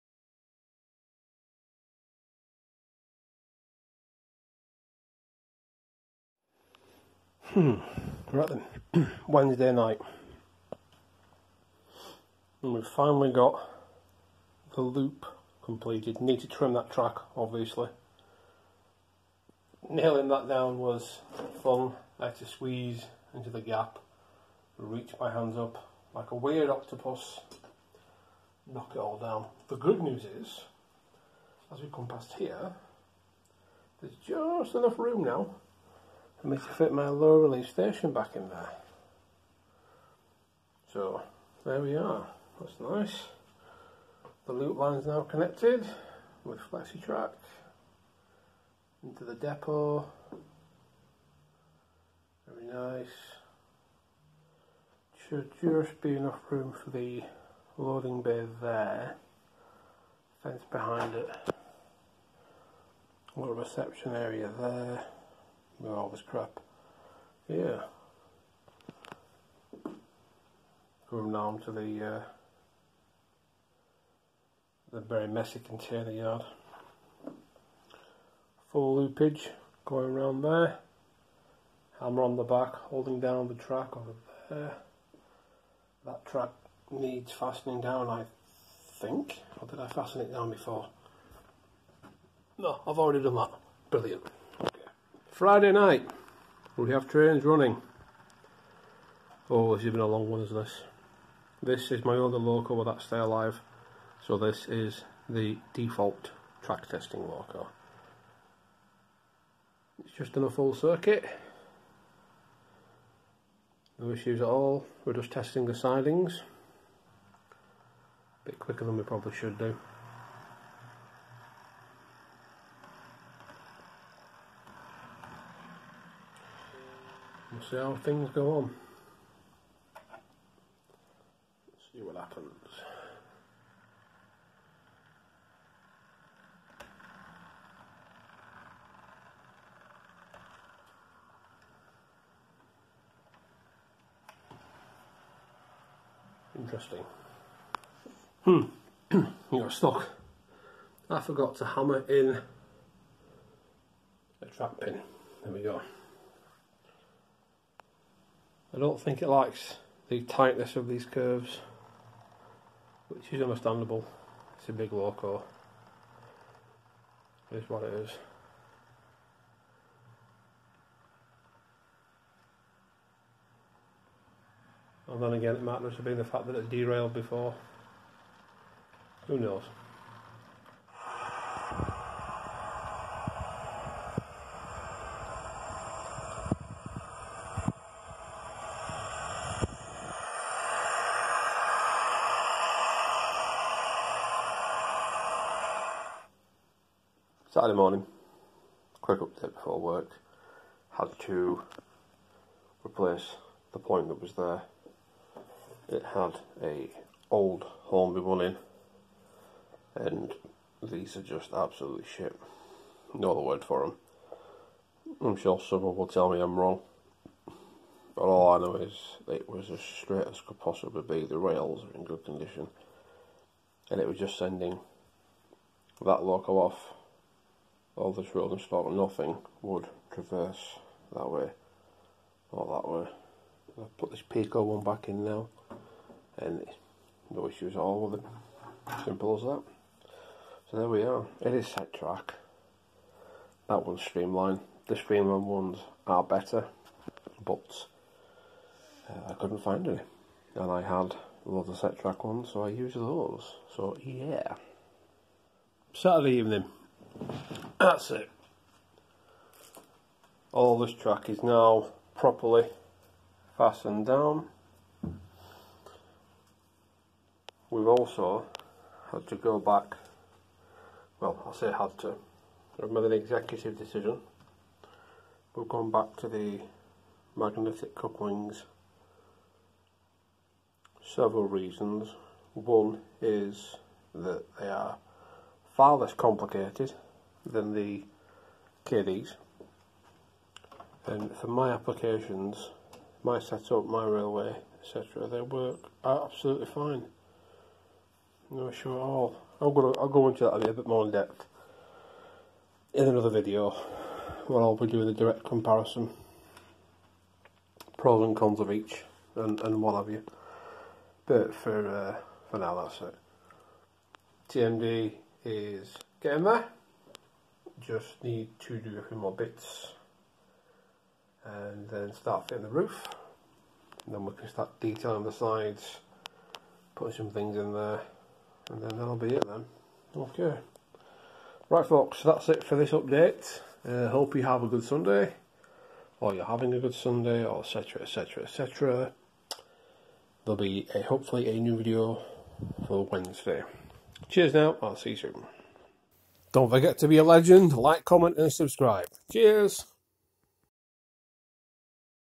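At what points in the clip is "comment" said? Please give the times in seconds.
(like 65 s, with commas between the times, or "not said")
348 s.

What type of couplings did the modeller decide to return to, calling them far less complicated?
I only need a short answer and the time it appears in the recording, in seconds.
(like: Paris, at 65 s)
Magnetic couplings, at 277 s.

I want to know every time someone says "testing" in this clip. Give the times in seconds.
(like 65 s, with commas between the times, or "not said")
106 s, 115 s.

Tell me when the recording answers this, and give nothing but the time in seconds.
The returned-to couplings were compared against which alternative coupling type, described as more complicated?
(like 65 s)
288 s.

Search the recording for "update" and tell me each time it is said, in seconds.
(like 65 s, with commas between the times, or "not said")
199 s, 332 s.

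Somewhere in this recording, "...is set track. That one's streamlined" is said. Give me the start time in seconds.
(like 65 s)
241 s.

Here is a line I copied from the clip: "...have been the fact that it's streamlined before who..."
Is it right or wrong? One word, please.
wrong.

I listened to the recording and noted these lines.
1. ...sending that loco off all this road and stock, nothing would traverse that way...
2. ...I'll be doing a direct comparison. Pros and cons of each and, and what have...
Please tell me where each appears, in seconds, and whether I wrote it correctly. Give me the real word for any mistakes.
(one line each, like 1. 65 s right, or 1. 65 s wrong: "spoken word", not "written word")
1. 224 s right
2. 304 s right.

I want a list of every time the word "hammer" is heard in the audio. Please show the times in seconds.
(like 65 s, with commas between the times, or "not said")
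81 s, 151 s.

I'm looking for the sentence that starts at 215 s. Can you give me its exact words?
I'm sure someone will tell me I'm wrong, but all I know is it was as straight as could possibly be.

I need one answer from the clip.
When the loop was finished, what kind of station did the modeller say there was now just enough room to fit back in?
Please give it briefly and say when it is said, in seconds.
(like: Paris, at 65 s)
low release station, at 37 s.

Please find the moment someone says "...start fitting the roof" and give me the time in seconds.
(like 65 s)
322 s.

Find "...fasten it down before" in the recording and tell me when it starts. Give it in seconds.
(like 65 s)
89 s.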